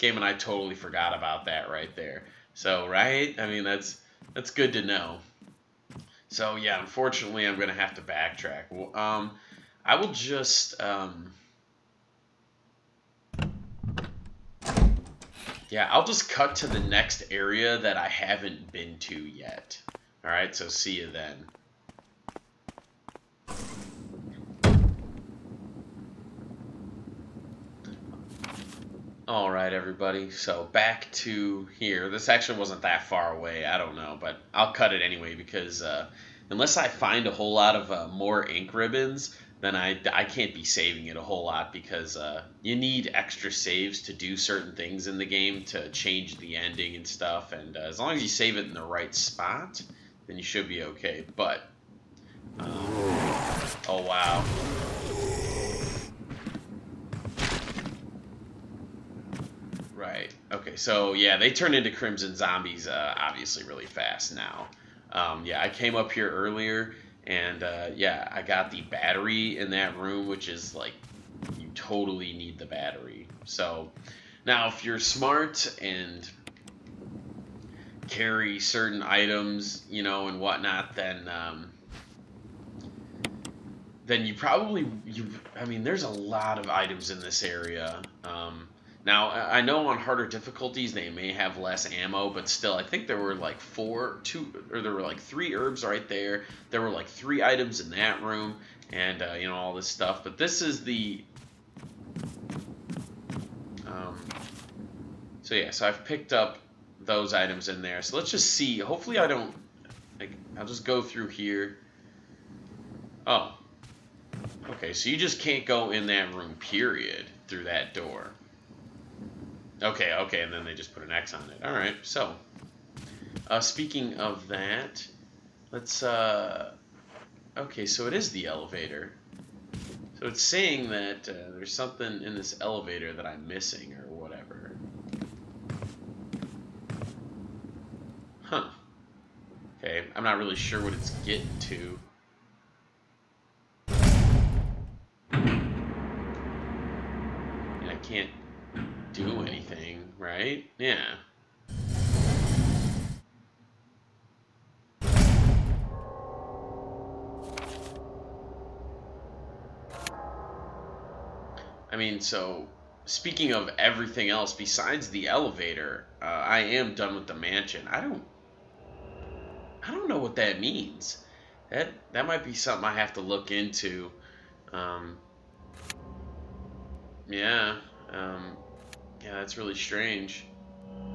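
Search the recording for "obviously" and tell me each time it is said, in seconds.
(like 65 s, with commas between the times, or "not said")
63 s.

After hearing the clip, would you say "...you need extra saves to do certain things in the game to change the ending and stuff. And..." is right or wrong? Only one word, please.
right.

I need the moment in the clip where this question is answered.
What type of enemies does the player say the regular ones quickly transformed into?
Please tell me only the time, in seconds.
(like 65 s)
61 s.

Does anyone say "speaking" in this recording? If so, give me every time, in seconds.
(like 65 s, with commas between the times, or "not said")
123 s, 163 s.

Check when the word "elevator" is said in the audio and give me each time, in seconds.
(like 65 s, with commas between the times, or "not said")
128 s, 132 s, 165 s.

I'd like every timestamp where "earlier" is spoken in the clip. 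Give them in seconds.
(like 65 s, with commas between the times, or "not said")
66 s.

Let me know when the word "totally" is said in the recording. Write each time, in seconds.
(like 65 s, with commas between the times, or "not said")
0 s, 71 s.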